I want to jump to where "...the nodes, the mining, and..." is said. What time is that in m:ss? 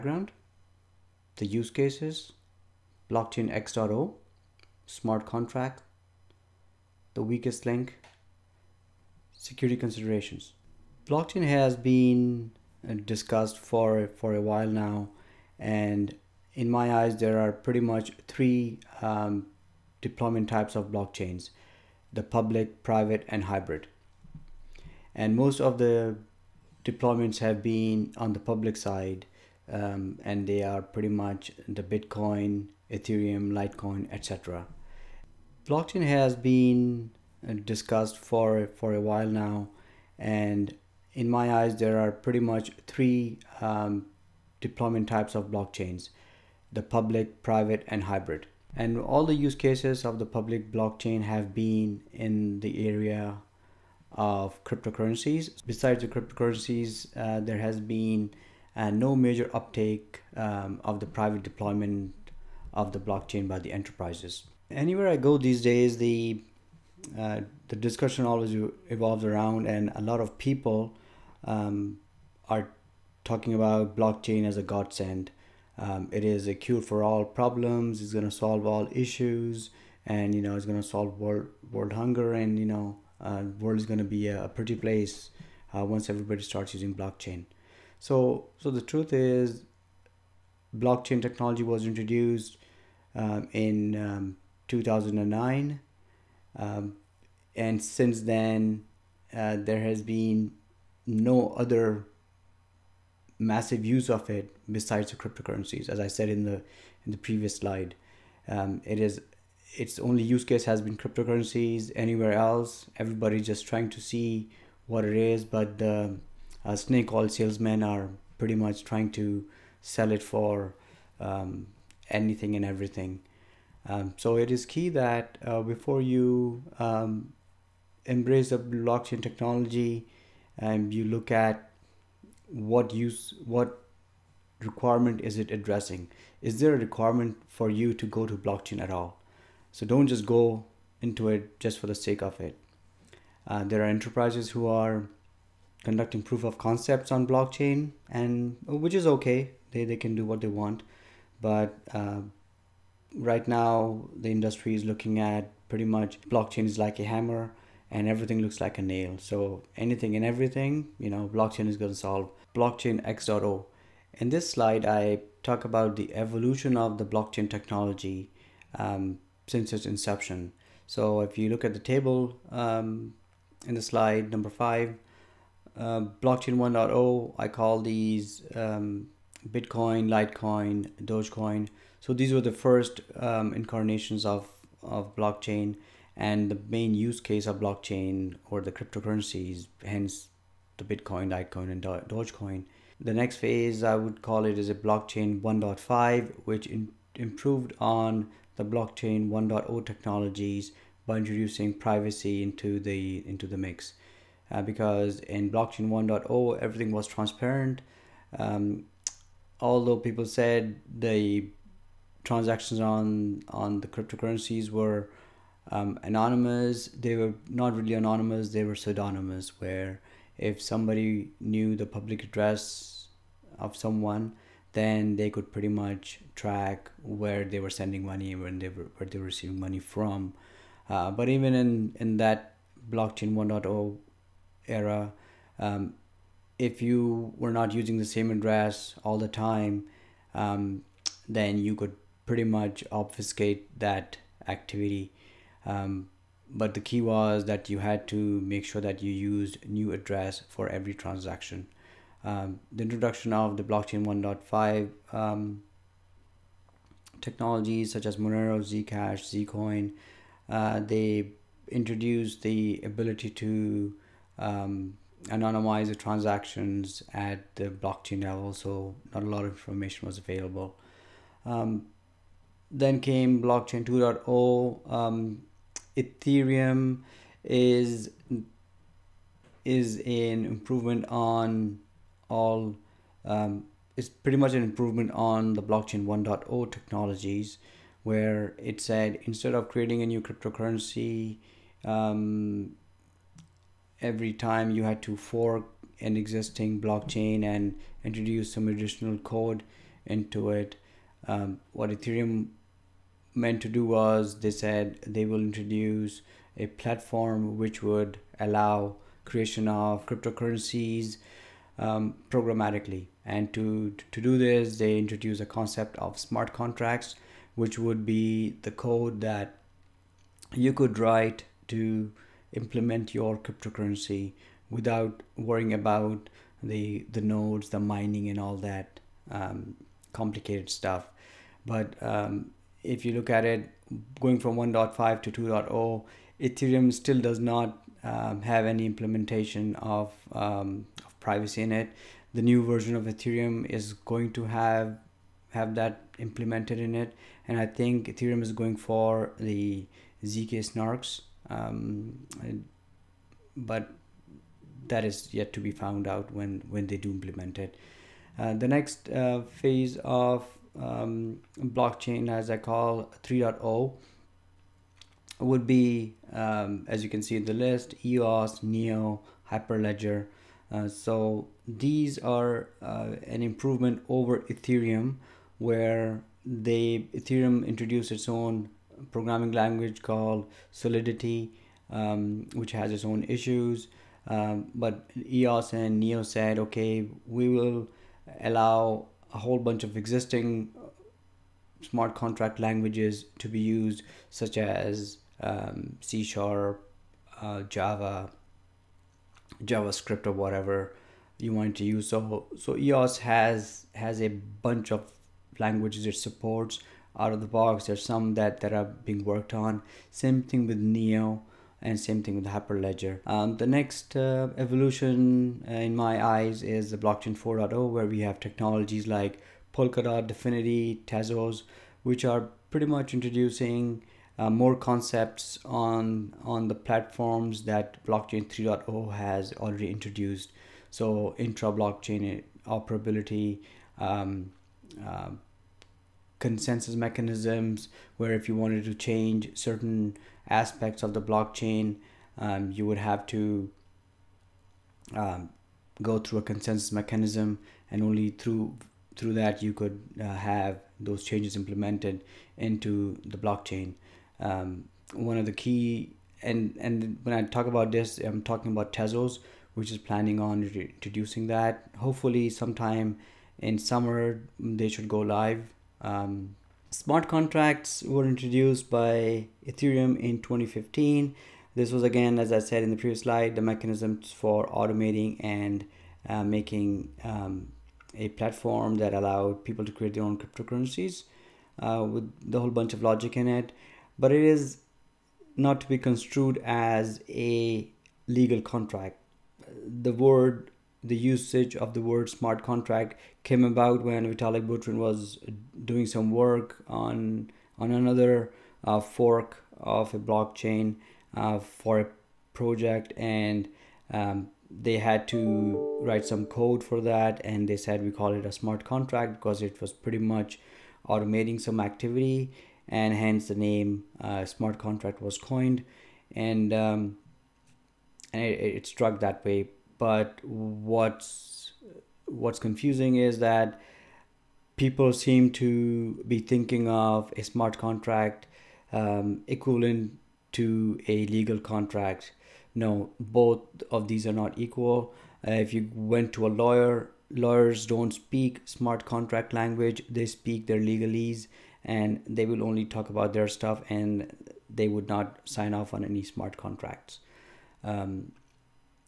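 5:27.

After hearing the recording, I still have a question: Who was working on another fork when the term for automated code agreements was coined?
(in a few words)
Vitalik Buterin.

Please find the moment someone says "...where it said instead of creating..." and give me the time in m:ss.
4:48.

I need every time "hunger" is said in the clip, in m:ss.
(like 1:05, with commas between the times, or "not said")
1:21.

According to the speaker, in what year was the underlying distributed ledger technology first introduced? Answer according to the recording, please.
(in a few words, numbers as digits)
2009.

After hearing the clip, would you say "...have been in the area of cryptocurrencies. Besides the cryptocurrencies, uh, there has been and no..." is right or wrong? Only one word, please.
right.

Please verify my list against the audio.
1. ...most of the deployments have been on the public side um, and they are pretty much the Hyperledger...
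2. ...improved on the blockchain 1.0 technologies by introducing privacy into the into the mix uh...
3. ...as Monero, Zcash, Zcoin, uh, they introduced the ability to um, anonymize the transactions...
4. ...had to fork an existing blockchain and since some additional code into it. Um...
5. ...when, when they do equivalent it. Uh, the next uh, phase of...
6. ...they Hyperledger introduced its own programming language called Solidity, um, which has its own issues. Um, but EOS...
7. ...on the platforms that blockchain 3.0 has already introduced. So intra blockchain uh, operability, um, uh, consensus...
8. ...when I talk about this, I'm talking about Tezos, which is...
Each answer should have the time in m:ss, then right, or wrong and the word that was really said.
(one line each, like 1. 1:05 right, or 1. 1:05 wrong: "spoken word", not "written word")
1. 0:25 wrong: "Bitcoin", not "Hyperledger"
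2. 3:17 right
3. 4:18 right
4. 4:54 wrong: "introduce", not "since"
5. 5:56 wrong: "implement", not "equivalent"
6. 6:16 wrong: "Ethereum", not "Hyperledger"
7. 7:06 right
8. 7:37 right.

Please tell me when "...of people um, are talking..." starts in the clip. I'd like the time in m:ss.
1:10.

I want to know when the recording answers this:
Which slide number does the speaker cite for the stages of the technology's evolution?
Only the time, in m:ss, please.
2:54.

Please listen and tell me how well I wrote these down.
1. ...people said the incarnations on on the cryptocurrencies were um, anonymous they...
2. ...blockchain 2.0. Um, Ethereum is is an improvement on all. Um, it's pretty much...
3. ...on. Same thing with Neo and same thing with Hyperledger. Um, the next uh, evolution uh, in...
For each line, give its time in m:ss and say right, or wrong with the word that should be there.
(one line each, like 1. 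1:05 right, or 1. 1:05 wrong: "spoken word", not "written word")
1. 3:29 wrong: "transactions", not "incarnations"
2. 4:33 right
3. 6:49 right.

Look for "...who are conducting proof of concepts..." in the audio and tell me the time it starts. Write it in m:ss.
2:24.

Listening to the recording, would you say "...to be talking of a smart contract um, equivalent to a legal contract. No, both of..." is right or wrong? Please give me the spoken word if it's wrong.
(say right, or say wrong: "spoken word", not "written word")
wrong: "thinking", not "talking".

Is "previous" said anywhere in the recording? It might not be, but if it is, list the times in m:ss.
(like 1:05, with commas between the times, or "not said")
1:47, 7:52.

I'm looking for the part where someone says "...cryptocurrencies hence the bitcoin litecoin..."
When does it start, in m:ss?
3:08.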